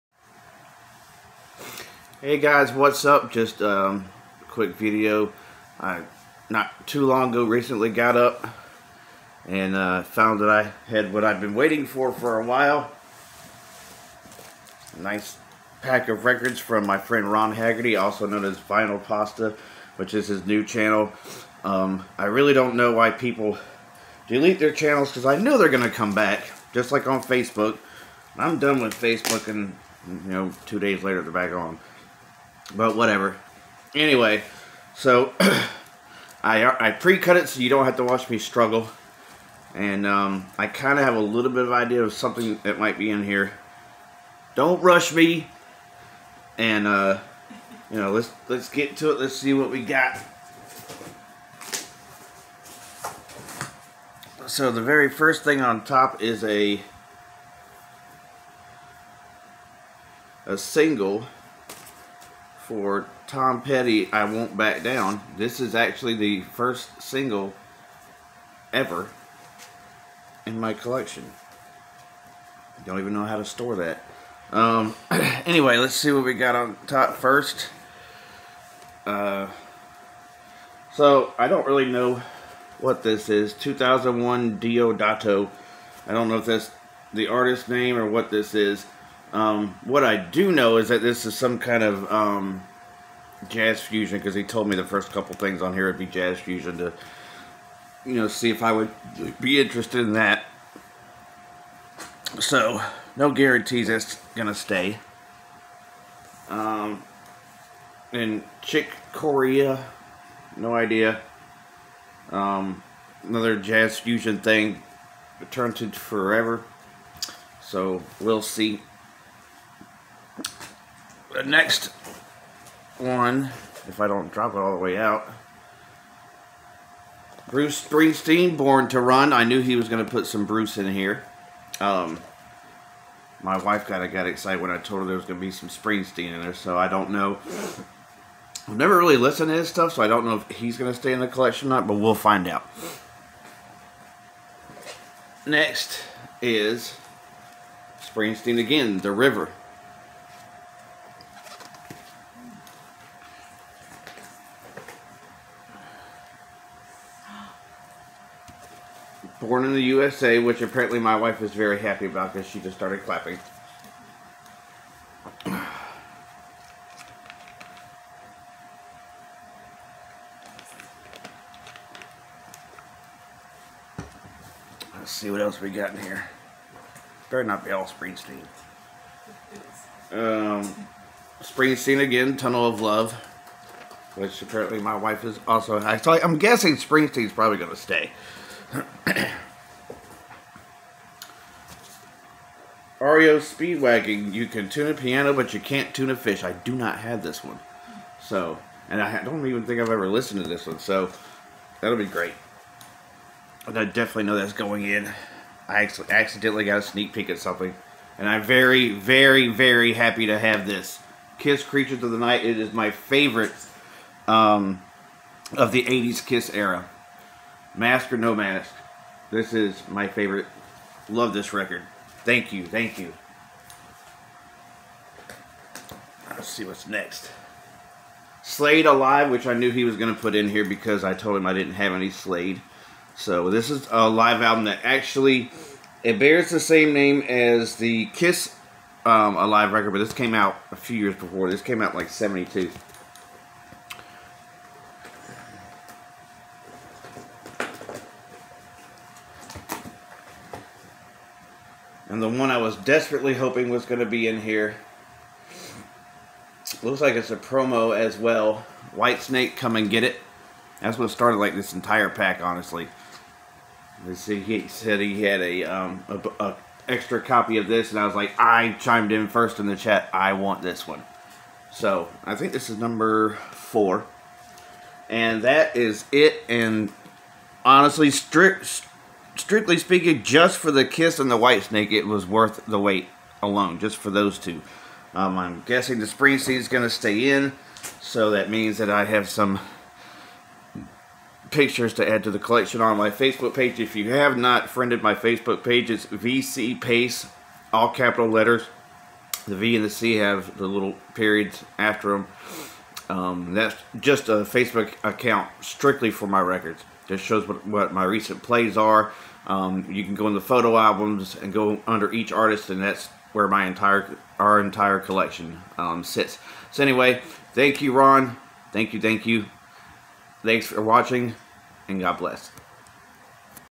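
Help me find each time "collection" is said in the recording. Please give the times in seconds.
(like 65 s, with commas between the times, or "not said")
70 s, 141 s, 292 s, 314 s.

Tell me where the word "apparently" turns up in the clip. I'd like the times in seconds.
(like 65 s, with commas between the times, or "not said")
160 s, 184 s.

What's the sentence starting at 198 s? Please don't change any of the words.
So, and I don't even think I've ever listened to this one, so that'll be great.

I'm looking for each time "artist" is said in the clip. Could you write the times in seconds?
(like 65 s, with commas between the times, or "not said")
87 s, 312 s.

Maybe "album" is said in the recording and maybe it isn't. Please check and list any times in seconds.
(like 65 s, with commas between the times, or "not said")
234 s, 310 s.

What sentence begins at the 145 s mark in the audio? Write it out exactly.
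Next is Springsteen again, The River.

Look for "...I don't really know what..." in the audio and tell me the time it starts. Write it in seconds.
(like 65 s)
81 s.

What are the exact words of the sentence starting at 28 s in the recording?
I'm done with Facebook and, you know, two days later they're back on.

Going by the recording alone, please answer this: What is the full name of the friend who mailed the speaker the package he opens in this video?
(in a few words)
Ron Haggerty.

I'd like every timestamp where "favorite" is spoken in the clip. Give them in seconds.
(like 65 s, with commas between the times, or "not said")
212 s, 220 s.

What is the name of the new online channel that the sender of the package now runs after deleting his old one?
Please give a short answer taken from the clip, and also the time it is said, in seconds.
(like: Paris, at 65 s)
Vinyl Pasta, at 18 s.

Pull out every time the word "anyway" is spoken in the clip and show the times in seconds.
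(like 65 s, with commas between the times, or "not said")
33 s, 75 s, 316 s.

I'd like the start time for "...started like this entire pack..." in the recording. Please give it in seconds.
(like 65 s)
261 s.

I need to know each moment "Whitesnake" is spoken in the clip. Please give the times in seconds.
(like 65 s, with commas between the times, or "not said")
258 s, 281 s.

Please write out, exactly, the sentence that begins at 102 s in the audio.
So, no guarantees it's going to stay.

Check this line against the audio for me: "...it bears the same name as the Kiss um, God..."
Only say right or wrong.
wrong.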